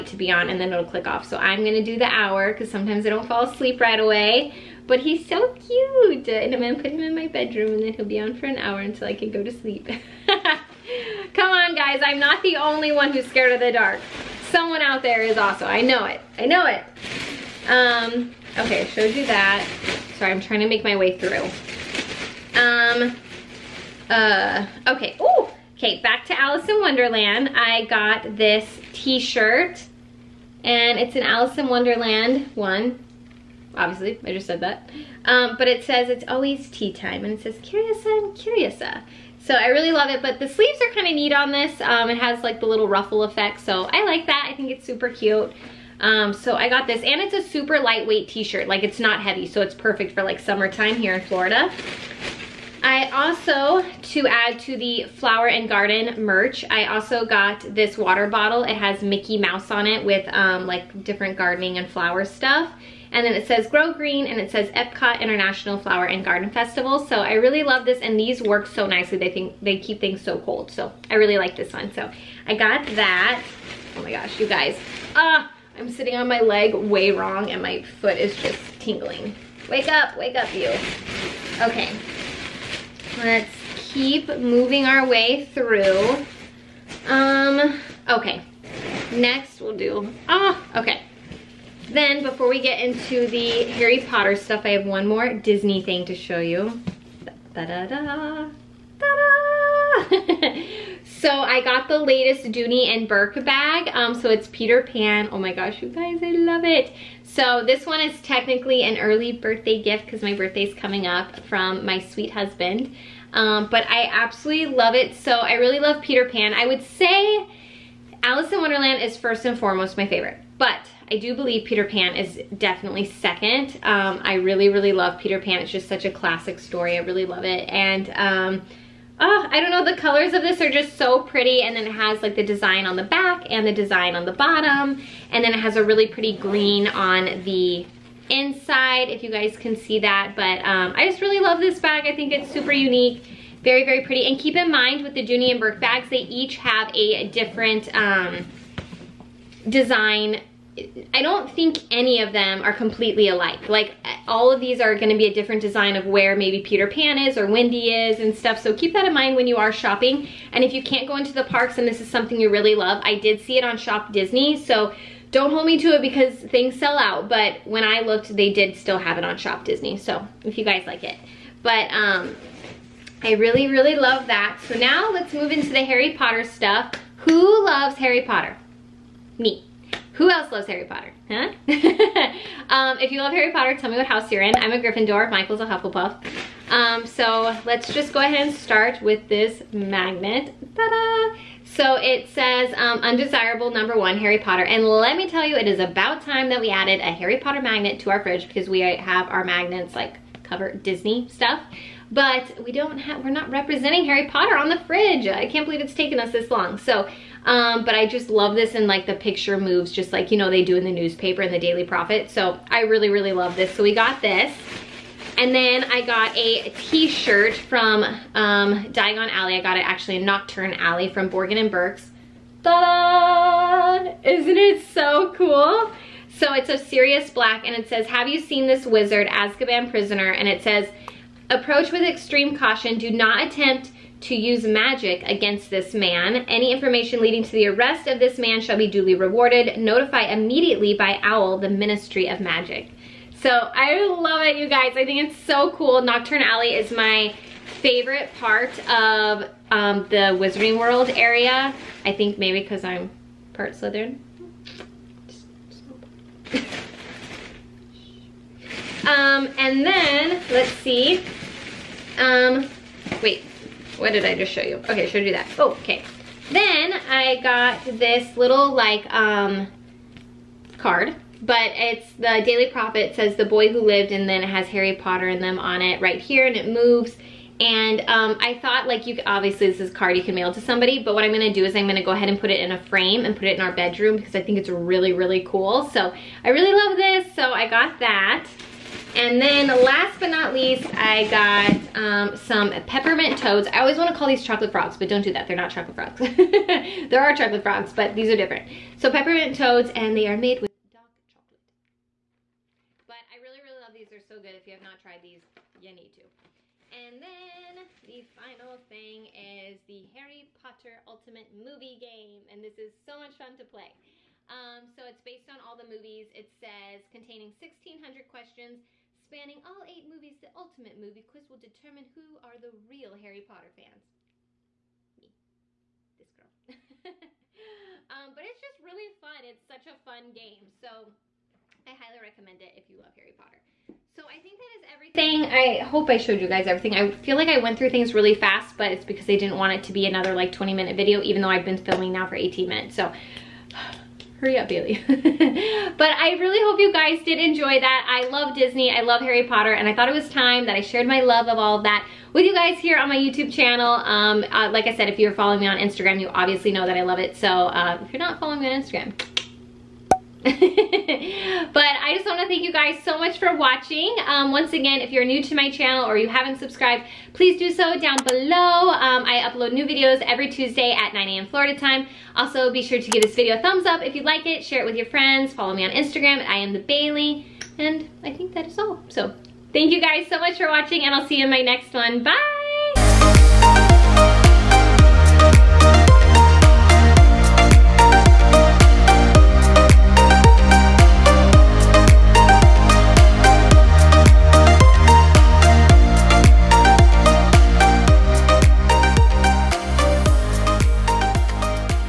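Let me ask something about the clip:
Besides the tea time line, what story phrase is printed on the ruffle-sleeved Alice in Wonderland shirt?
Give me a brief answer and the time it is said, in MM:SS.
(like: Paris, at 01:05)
Curiouser and Curiouser, at 00:37.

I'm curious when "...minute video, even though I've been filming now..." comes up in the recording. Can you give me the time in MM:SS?
05:40.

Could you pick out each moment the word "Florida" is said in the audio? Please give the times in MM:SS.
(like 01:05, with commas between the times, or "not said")
00:51, 06:11.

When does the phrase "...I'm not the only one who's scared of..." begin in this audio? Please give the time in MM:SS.
00:12.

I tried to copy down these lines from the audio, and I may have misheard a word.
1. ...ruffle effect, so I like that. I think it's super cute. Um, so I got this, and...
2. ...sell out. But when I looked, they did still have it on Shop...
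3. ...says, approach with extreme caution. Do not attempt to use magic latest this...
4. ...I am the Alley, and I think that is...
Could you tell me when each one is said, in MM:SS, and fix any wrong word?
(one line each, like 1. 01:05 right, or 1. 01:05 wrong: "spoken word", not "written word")
1. 00:42 right
2. 02:46 right
3. 03:50 wrong: "against", not "latest"
4. 06:16 wrong: "Bailey", not "Alley".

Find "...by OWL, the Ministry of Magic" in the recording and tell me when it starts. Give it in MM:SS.
04:00.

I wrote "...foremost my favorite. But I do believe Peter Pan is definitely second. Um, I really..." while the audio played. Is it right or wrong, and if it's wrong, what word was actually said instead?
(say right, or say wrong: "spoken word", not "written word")
right.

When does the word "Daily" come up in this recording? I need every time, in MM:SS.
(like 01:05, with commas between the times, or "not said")
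03:31, 04:32.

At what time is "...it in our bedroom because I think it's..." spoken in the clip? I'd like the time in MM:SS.
04:43.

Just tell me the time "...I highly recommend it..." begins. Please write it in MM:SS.
05:31.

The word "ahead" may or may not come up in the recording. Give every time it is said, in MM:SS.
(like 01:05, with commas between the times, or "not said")
03:08, 04:42.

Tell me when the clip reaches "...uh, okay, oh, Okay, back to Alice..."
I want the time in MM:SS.
00:24.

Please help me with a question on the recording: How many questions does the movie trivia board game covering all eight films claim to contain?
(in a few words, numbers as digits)
1,600.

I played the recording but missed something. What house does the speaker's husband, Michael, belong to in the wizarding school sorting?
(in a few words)
Hufflepuff.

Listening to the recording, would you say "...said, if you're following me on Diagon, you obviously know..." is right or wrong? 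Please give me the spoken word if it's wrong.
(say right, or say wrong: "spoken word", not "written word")
wrong: "Instagram", not "Diagon".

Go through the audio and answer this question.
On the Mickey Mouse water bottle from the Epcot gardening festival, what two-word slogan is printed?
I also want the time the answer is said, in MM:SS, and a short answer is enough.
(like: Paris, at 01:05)
Grow Green, at 01:03.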